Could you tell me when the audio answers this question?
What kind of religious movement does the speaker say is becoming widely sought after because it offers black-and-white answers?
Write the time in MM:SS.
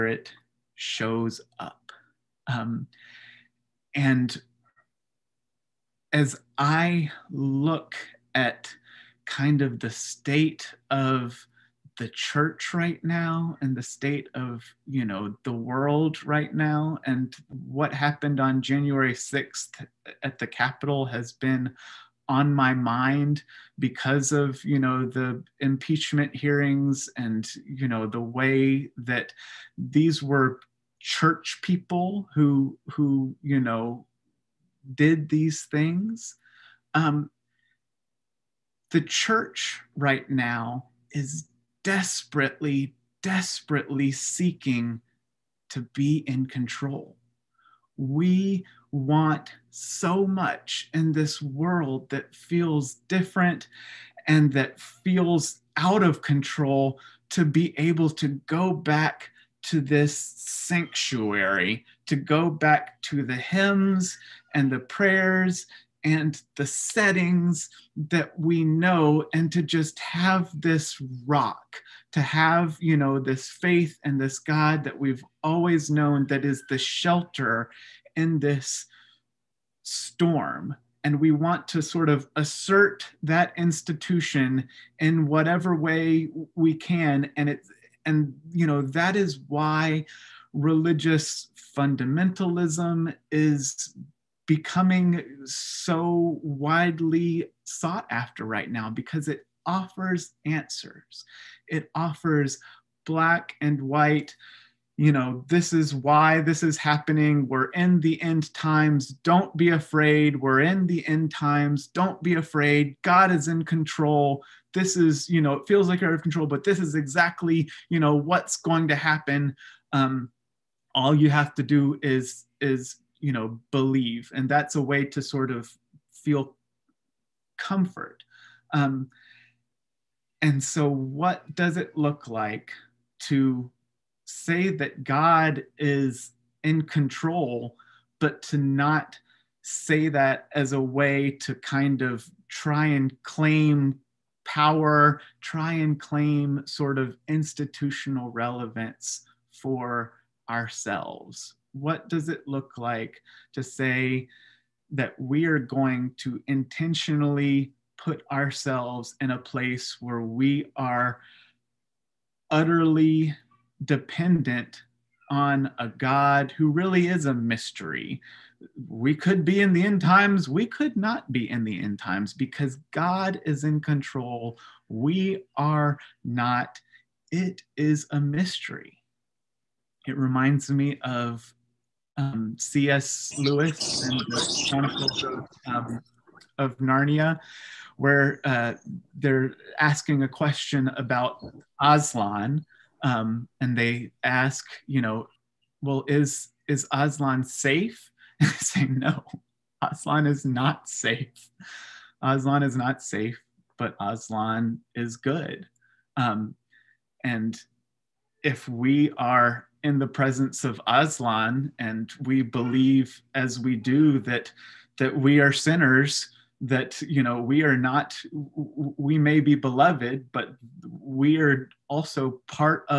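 01:30.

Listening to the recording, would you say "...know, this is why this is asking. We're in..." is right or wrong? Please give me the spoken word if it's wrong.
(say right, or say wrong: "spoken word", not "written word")
wrong: "happening", not "asking".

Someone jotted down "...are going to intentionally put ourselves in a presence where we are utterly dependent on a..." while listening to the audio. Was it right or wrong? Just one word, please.
wrong.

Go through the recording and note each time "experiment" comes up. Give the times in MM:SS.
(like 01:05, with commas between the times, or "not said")
not said.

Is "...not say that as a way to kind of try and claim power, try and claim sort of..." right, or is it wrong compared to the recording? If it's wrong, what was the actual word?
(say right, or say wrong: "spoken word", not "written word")
right.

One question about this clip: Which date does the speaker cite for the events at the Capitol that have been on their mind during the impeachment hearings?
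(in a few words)
January 6th.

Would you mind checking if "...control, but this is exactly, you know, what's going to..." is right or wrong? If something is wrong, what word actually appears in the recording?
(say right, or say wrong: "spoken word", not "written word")
right.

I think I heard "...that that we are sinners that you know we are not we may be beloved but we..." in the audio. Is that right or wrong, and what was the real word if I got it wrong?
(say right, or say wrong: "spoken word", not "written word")
right.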